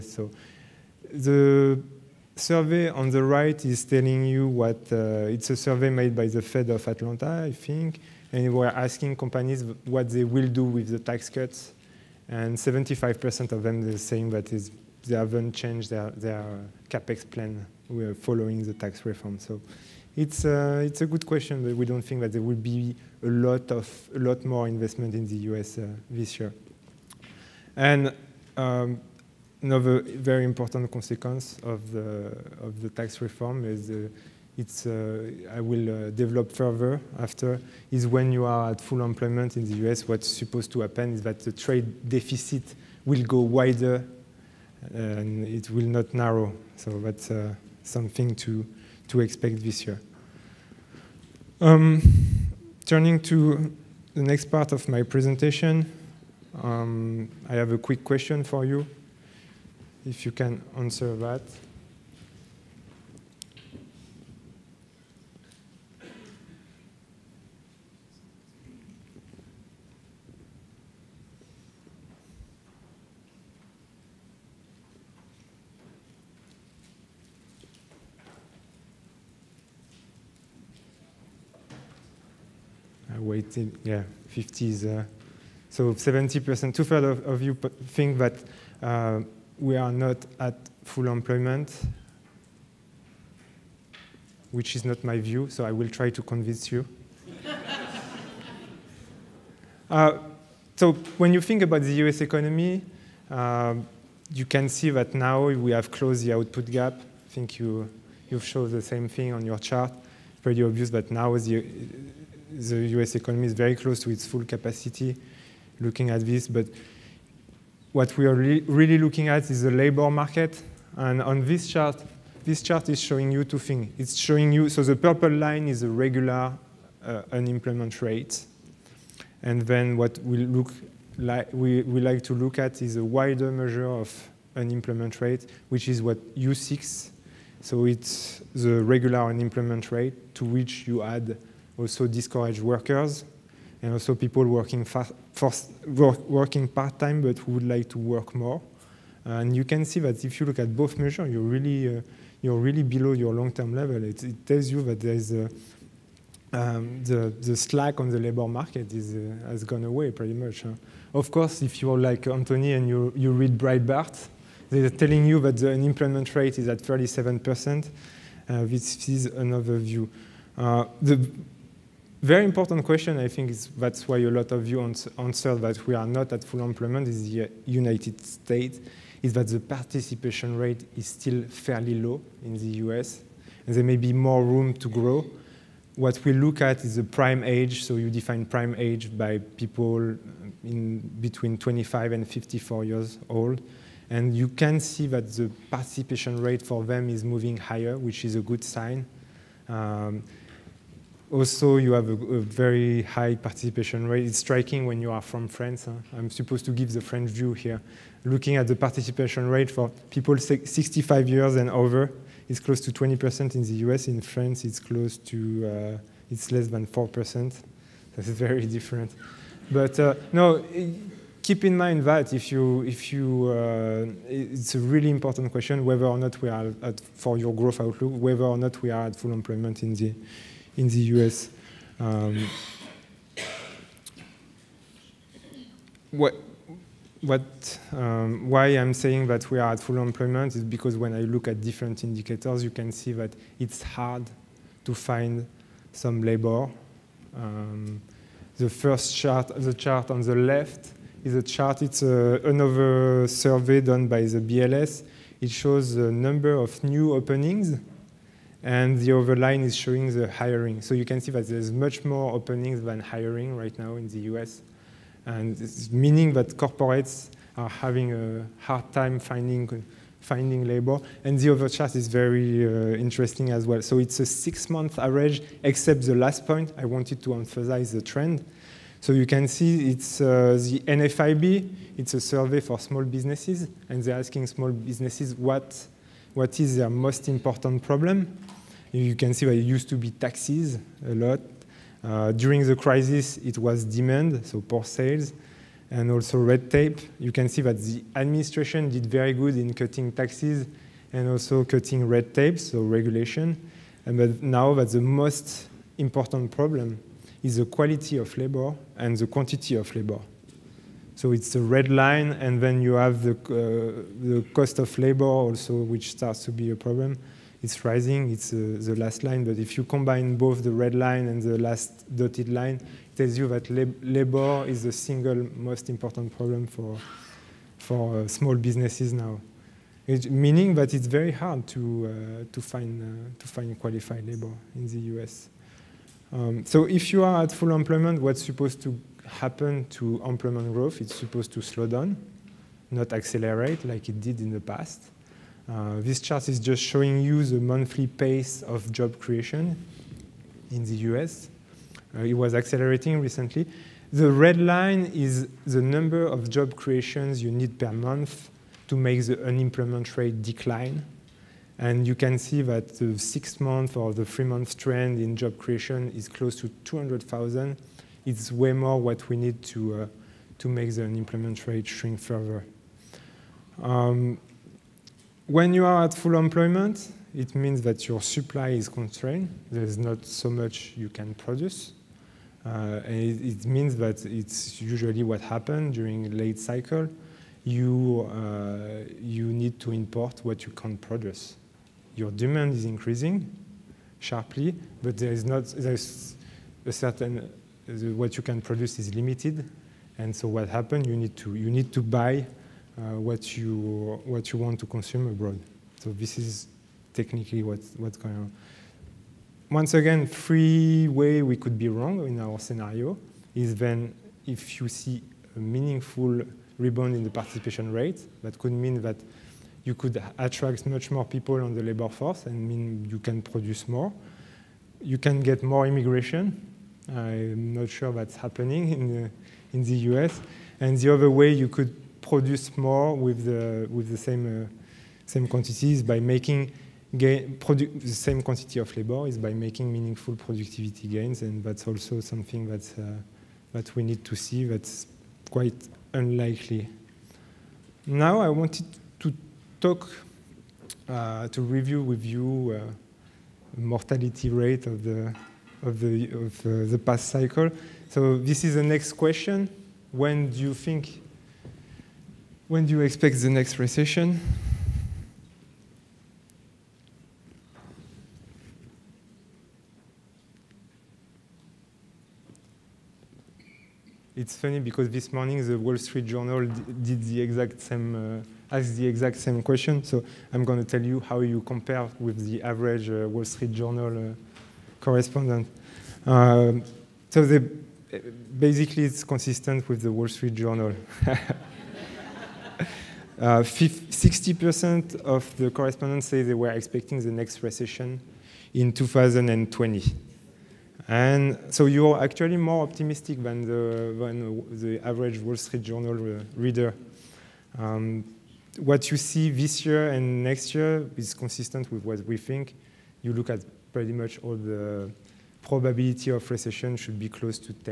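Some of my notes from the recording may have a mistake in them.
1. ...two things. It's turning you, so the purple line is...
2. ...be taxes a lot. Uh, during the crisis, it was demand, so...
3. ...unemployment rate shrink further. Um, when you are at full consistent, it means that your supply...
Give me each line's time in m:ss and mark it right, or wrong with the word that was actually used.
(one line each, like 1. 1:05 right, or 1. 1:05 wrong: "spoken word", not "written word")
1. 2:03 wrong: "showing", not "turning"
2. 4:49 right
3. 6:11 wrong: "employment", not "consistent".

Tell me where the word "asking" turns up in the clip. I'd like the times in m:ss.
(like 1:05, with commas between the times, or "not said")
0:08, 4:44.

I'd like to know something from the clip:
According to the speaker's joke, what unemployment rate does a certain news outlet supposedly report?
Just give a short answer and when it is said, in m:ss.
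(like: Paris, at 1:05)
37%, at 2:46.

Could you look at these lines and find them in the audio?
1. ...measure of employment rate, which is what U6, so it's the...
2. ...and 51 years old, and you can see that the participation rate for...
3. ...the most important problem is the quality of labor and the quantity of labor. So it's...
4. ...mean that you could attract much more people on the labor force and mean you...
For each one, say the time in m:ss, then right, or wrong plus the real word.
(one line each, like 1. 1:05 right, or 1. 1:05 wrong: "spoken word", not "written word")
1. 2:13 wrong: "unemployment", not "employment"
2. 3:12 wrong: "54", not "51"
3. 5:04 right
4. 6:58 right.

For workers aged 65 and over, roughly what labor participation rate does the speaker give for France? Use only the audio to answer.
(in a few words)
less than 4%.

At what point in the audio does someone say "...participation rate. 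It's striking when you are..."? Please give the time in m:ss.
3:23.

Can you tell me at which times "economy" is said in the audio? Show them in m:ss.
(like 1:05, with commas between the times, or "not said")
1:42, 1:53.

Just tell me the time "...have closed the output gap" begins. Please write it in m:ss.
1:45.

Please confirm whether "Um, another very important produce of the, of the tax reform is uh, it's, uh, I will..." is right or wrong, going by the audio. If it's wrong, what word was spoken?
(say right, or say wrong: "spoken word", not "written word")
wrong: "consequence", not "produce".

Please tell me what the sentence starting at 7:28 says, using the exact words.
Now I wanted to talk, uh, to review with you mortality rate of the of the of the past cycle.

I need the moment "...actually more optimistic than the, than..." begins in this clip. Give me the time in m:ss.
8:22.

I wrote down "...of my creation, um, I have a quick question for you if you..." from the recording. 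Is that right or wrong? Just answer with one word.
wrong.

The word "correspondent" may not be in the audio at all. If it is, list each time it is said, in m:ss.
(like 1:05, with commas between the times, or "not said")
8:04, 8:15.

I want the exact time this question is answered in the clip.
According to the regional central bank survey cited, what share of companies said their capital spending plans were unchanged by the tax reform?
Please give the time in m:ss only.
0:12.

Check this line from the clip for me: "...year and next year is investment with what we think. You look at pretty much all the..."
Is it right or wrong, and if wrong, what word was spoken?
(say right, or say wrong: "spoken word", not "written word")
wrong: "consistent", not "investment".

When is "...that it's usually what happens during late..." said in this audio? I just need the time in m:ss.
6:23.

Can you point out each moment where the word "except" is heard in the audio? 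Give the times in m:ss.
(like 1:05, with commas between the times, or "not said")
4:35.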